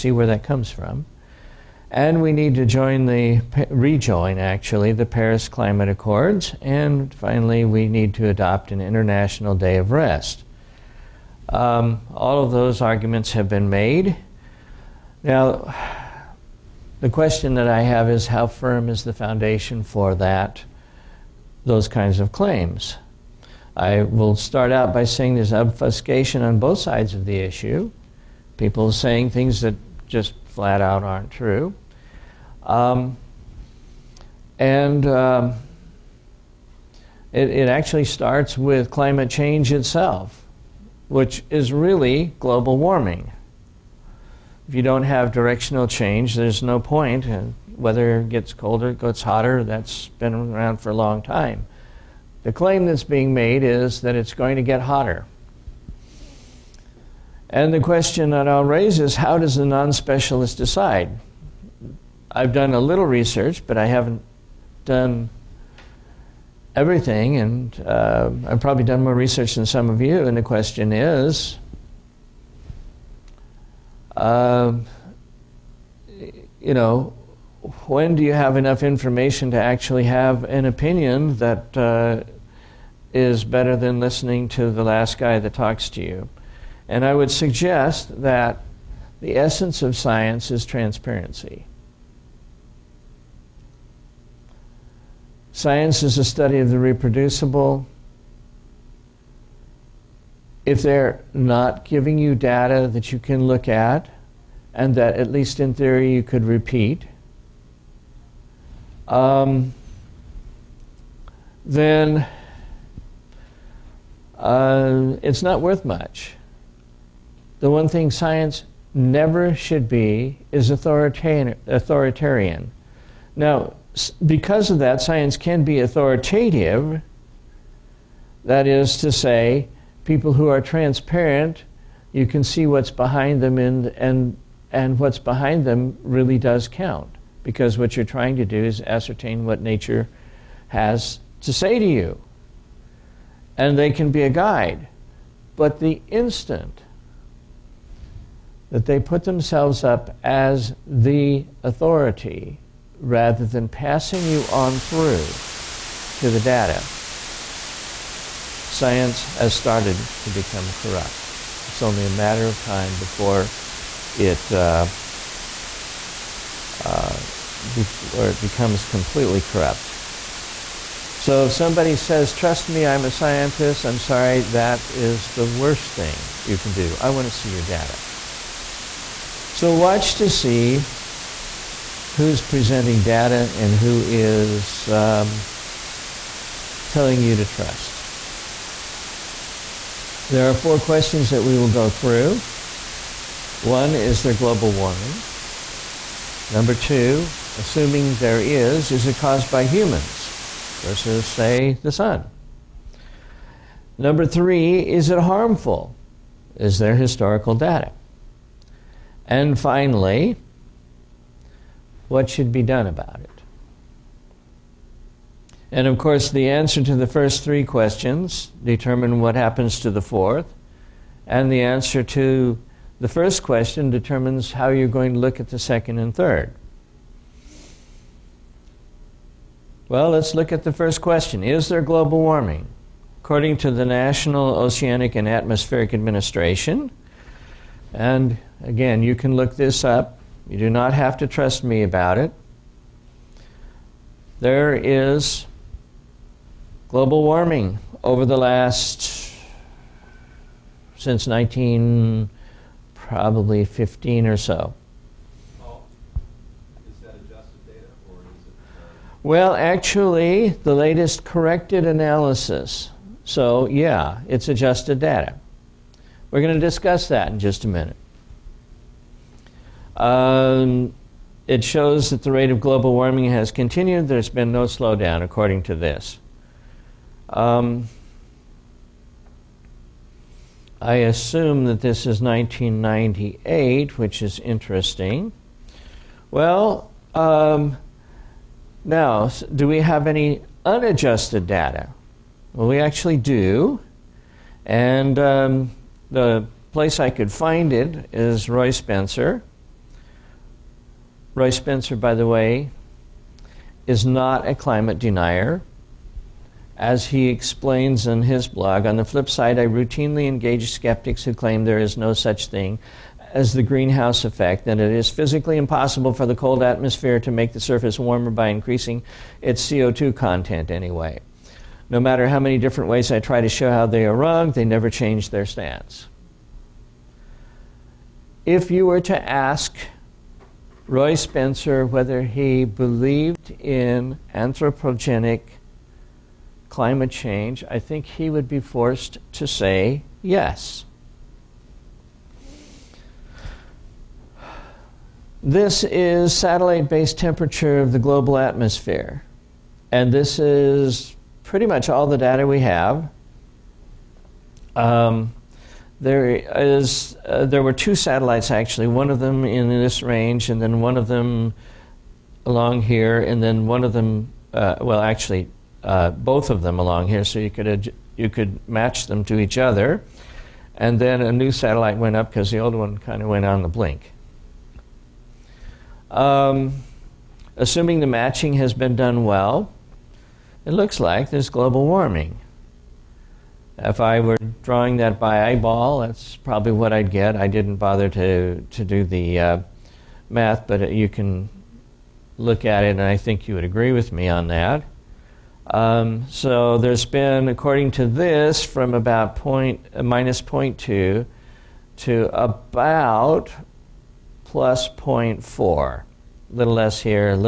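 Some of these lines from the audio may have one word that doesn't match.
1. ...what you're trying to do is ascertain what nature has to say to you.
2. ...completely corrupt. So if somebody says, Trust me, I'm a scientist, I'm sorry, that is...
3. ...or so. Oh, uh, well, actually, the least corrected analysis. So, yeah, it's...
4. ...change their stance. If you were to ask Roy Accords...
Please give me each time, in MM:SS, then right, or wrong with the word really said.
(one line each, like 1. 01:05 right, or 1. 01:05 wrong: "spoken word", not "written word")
1. 02:17 right
2. 02:48 right
3. 04:14 wrong: "latest", not "least"
4. 05:24 wrong: "Spencer", not "Accords".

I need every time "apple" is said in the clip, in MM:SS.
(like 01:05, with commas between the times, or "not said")
not said.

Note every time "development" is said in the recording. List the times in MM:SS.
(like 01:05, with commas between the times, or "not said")
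not said.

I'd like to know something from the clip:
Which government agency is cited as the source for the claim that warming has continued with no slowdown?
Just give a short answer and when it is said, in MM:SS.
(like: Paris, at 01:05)
National Oceanic and Atmospheric Administration, at 03:53.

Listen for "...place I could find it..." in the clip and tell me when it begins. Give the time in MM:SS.
04:56.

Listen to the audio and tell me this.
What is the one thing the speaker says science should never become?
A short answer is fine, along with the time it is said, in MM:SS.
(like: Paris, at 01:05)
Authoritarian, at 02:00.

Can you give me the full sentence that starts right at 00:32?
Um, and um, it, it actually starts with climate change itself, which is really global warming.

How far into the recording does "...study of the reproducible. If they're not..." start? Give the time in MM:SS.
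01:36.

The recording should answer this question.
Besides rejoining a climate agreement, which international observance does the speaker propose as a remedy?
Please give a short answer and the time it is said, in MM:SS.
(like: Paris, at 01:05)
International Day of Rest, at 00:08.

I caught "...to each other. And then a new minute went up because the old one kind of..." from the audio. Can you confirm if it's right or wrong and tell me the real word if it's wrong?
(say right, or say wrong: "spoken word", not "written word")
wrong: "satellite", not "minute".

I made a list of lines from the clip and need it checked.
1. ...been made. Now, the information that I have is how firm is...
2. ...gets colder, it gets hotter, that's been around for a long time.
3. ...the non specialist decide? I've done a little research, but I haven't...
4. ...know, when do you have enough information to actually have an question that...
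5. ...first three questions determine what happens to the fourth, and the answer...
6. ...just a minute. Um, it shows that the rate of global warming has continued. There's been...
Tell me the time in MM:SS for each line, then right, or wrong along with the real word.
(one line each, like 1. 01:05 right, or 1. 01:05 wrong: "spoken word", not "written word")
1. 00:13 wrong: "question", not "information"
2. 00:48 right
3. 00:59 right
4. 01:16 wrong: "opinion", not "question"
5. 03:37 right
6. 04:27 right.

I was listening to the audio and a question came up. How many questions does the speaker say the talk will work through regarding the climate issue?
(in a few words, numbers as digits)
4.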